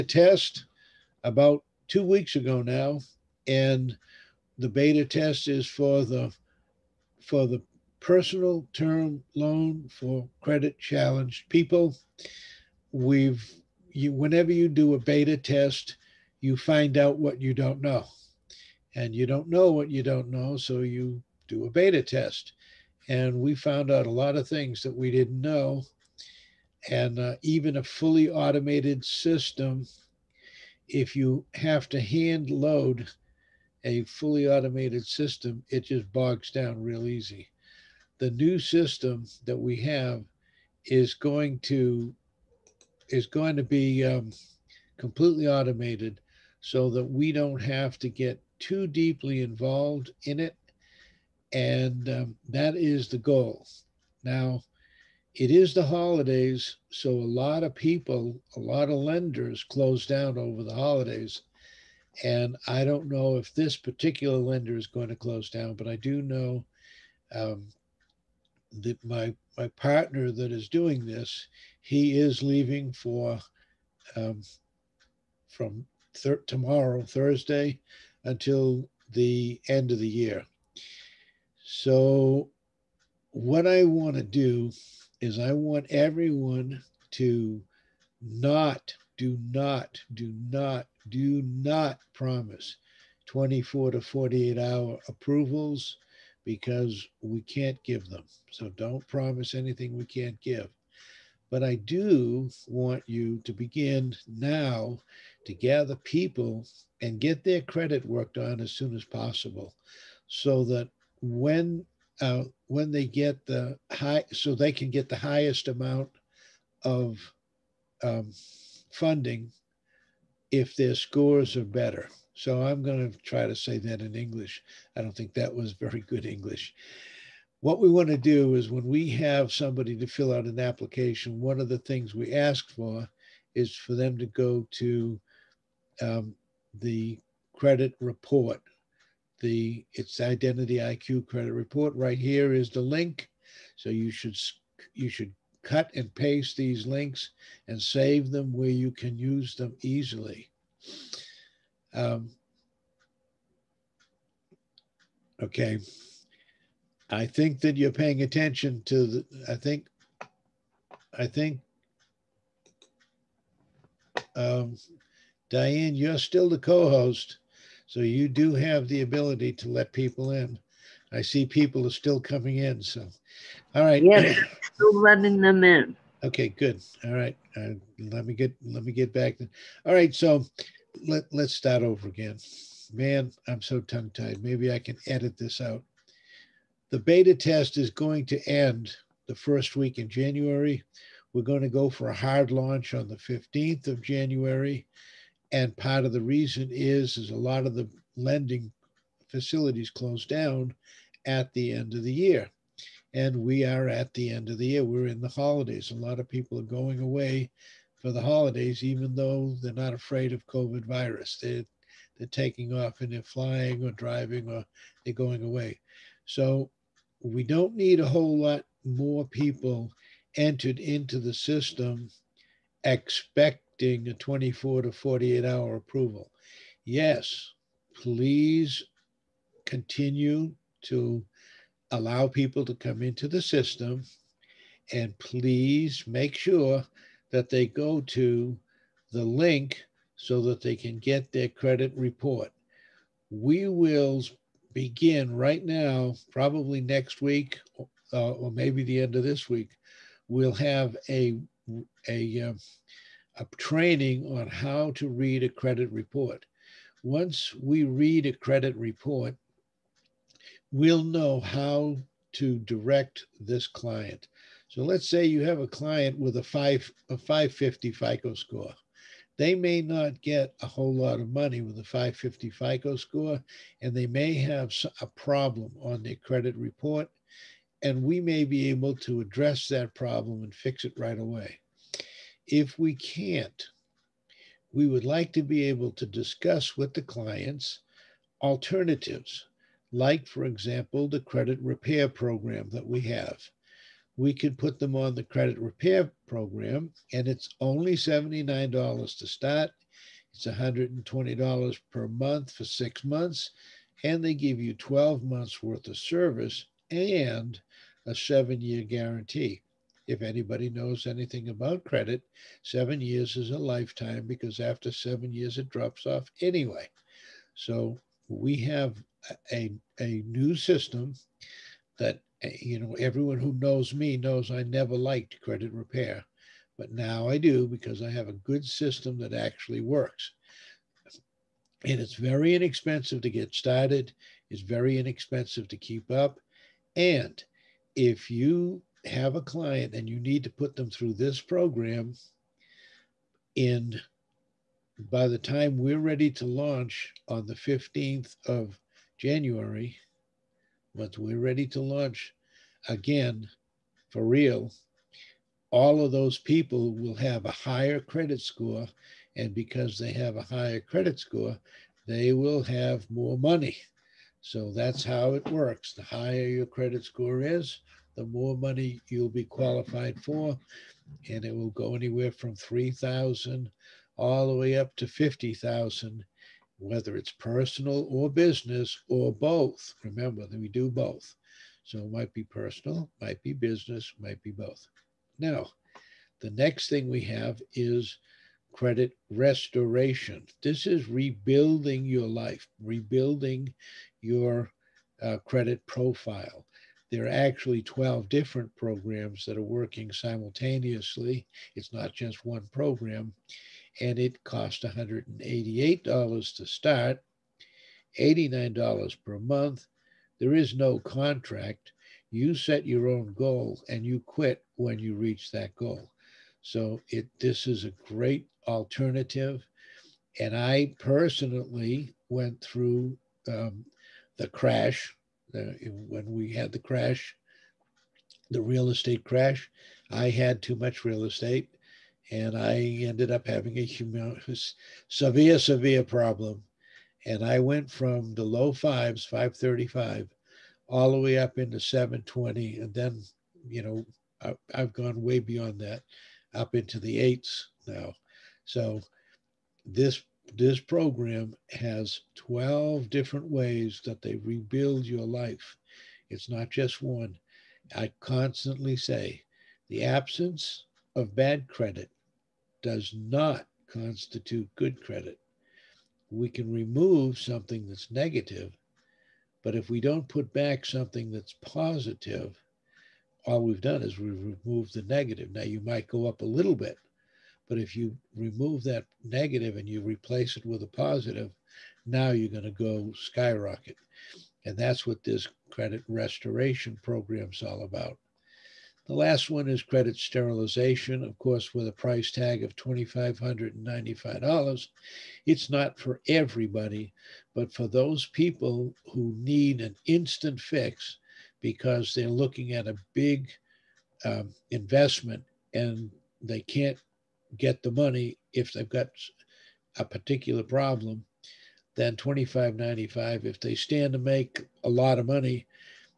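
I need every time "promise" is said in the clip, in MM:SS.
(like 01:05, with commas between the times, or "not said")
01:32, 01:39.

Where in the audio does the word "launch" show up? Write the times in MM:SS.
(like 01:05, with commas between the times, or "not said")
03:12, 05:46, 05:51.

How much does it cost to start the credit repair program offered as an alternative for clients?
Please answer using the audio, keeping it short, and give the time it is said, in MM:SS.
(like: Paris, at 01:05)
$79, at 04:57.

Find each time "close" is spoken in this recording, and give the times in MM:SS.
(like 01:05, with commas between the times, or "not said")
00:59, 01:05, 03:19.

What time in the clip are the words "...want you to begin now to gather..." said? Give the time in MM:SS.
01:42.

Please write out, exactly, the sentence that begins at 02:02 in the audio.
So I'm going to try to say that in English.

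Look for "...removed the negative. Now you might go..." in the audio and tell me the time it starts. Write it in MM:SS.
07:54.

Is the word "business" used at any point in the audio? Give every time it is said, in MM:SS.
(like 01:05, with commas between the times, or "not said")
06:18, 06:23.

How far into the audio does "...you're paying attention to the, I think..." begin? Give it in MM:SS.
02:37.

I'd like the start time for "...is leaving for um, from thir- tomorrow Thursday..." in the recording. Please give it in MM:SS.
01:12.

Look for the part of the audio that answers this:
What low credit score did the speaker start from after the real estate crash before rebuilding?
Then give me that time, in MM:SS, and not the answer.
07:19.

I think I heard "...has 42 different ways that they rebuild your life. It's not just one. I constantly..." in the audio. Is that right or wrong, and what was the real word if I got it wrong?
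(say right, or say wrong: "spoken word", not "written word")
wrong: "12", not "42".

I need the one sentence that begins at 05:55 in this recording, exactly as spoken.
All of those people will have a higher credit score.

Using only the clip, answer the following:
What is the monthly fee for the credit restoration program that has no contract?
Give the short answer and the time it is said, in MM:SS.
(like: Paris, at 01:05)
$89, at 06:48.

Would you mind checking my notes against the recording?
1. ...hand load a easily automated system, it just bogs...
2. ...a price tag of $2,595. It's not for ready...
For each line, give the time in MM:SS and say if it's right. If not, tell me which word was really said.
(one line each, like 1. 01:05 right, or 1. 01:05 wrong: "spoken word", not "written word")
1. 00:32 wrong: "fully", not "easily"
2. 08:11 wrong: "everybody", not "ready".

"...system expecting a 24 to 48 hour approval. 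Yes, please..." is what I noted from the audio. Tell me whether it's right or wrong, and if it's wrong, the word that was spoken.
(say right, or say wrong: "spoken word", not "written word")
right.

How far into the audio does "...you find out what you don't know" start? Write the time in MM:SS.
00:16.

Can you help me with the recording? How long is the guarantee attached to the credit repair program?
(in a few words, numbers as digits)
7 years.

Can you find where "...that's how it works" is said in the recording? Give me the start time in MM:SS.
06:04.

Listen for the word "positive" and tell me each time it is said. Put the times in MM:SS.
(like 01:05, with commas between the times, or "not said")
07:51, 08:00.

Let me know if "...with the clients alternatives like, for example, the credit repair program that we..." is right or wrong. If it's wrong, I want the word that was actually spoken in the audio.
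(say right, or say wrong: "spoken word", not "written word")
right.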